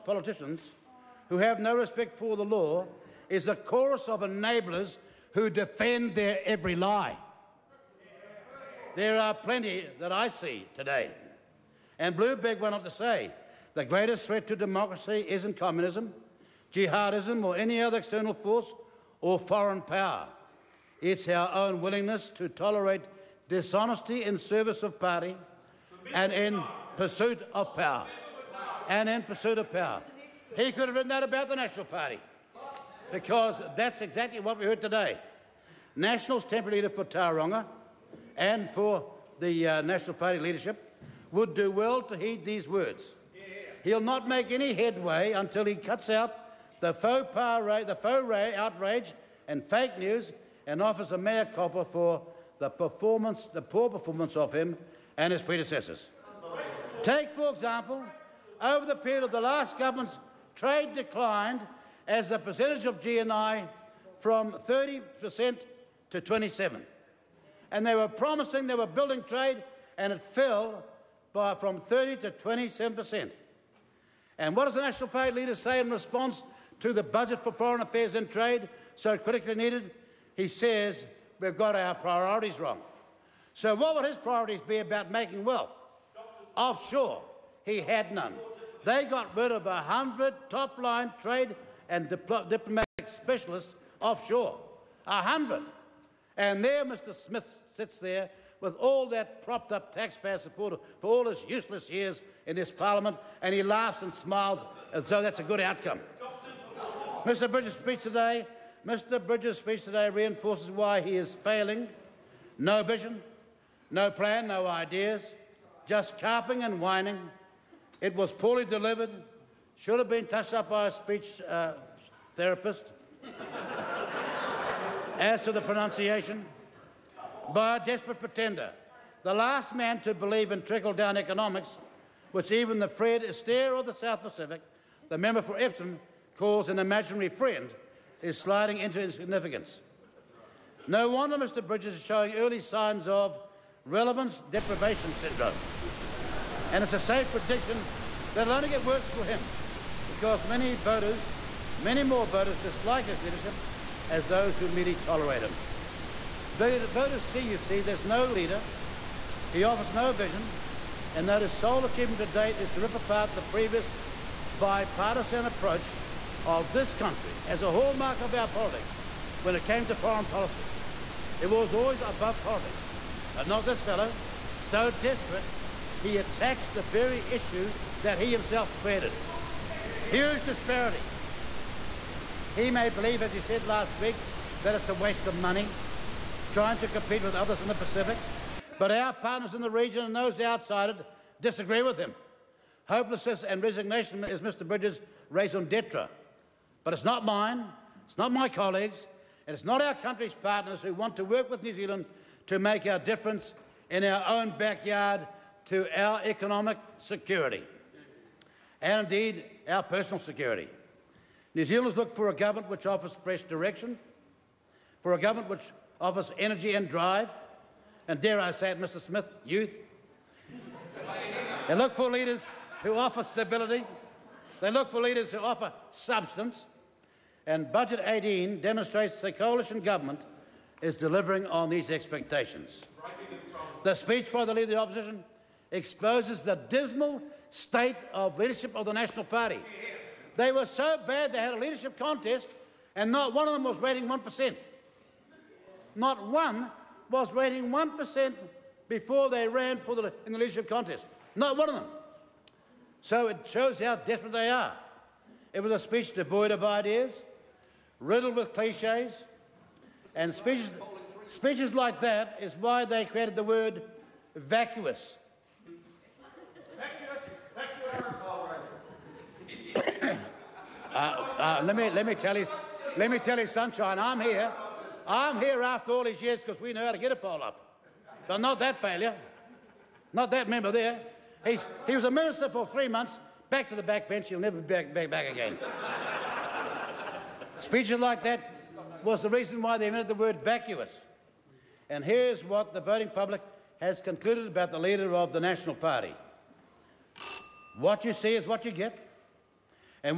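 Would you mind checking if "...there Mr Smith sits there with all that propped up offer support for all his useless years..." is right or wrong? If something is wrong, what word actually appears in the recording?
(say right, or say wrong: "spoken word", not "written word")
wrong: "taxpayer", not "offer".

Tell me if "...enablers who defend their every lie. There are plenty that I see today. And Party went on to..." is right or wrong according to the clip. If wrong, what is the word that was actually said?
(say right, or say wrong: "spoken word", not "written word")
wrong: "Bloomberg", not "Party".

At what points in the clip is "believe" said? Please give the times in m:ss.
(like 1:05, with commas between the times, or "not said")
2:10, 3:02.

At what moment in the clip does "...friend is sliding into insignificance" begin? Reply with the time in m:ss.
2:17.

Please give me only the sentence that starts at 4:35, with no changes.
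I'm here after all these years because we know how to get a poll up.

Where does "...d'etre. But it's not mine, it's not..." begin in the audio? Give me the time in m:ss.
3:15.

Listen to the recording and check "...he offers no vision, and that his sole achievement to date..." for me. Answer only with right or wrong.
right.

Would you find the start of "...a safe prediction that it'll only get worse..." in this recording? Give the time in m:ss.
2:26.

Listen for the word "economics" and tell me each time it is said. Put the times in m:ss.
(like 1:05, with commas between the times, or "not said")
2:11, 3:26.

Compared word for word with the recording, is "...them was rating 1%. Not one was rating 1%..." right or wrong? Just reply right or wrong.
right.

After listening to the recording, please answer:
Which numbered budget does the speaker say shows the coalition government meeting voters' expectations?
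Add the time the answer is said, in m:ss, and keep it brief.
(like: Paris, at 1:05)
Budget 18, at 3:47.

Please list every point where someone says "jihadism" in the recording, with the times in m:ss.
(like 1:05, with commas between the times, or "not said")
0:16.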